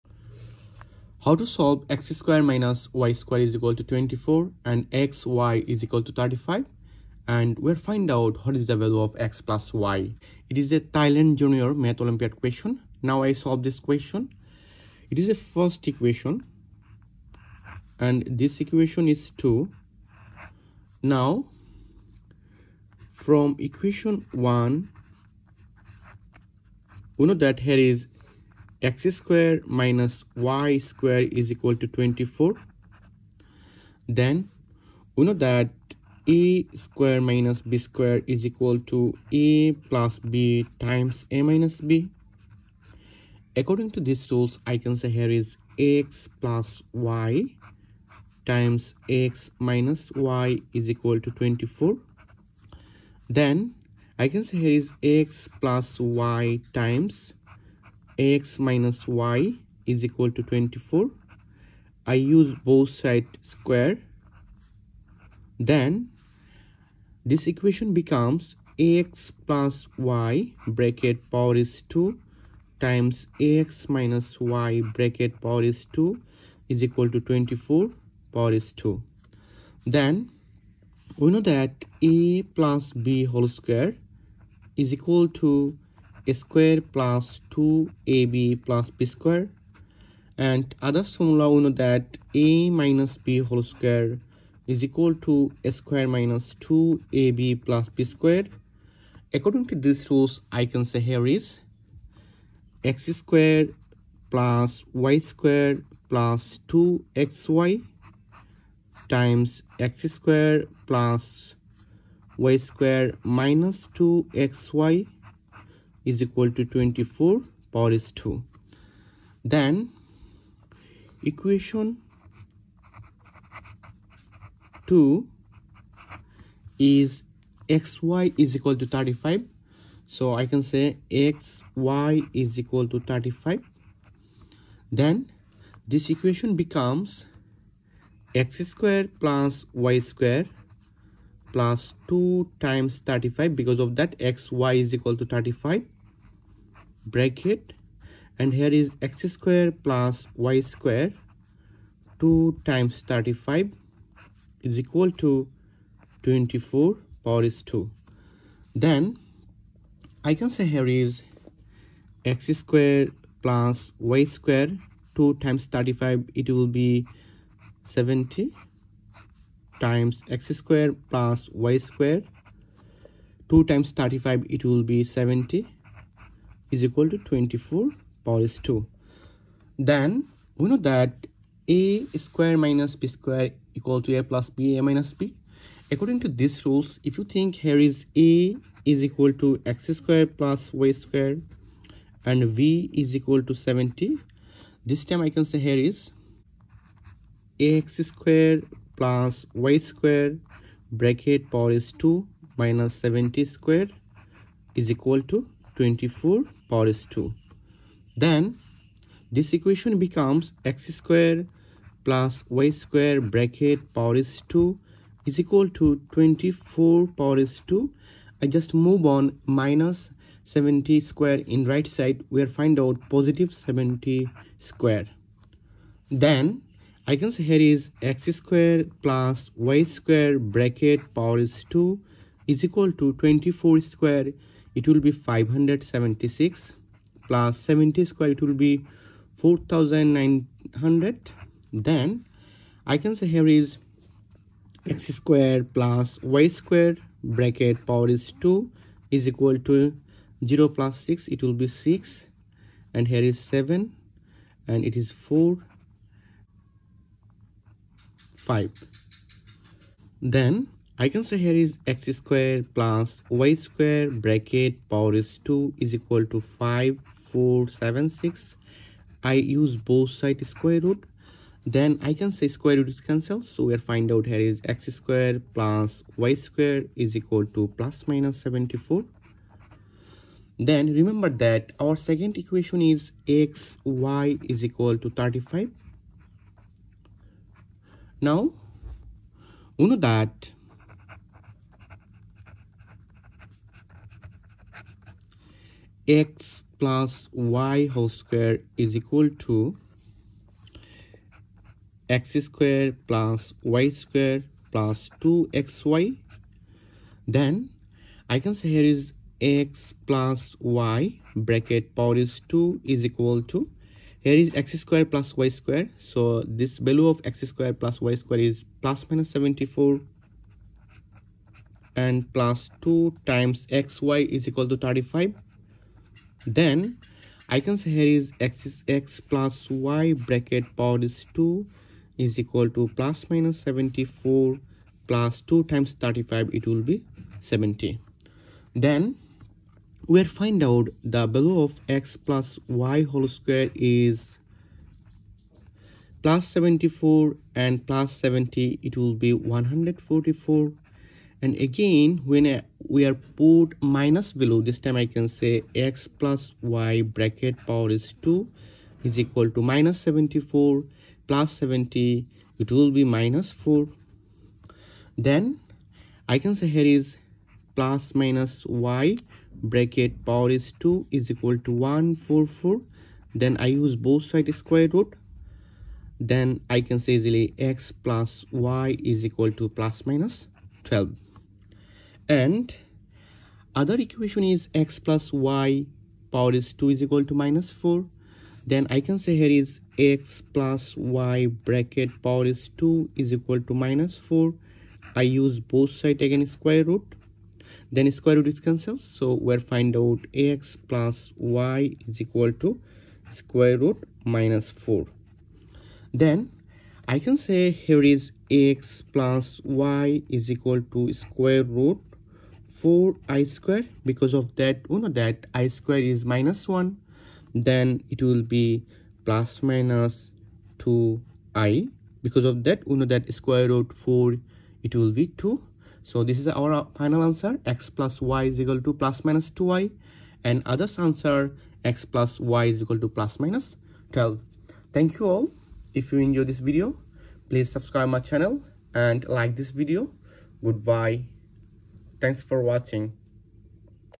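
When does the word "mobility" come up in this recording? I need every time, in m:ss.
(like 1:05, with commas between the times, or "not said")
not said.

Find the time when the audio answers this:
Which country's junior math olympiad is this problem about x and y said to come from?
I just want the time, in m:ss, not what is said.
0:10.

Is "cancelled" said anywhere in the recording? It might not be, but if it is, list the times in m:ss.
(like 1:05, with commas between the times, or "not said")
4:33, 6:38.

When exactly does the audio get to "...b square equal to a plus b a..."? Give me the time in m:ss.
3:02.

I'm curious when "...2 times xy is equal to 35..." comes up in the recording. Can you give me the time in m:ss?
5:22.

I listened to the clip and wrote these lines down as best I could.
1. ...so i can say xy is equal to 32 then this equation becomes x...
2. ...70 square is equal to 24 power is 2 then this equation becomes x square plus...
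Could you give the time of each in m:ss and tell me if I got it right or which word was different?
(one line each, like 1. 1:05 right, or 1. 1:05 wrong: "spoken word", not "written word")
1. 2:10 wrong: "35", not "32"
2. 3:23 right.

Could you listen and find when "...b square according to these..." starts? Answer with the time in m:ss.
1:37.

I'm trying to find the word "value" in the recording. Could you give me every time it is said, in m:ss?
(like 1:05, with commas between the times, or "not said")
0:08, 5:16, 5:41.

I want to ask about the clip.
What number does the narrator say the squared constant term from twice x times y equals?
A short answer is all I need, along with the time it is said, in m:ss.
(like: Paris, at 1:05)
4900, at 3:59.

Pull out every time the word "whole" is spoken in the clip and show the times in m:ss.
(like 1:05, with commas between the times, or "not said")
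1:23, 1:33, 4:57, 5:43.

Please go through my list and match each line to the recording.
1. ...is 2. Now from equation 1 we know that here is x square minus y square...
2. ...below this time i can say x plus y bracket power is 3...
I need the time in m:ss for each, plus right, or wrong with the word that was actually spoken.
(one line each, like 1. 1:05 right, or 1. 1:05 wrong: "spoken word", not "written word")
1. 0:19 right
2. 5:54 wrong: "2", not "3".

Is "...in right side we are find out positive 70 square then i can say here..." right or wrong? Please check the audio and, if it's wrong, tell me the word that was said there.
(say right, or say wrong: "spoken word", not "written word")
right.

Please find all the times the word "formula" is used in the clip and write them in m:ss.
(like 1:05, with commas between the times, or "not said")
1:31.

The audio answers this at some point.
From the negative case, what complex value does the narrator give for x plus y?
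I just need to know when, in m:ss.
7:08.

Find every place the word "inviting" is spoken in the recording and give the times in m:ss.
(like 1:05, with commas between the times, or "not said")
not said.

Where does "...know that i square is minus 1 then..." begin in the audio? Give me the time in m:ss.
6:54.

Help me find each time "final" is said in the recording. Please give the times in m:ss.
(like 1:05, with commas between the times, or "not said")
7:06.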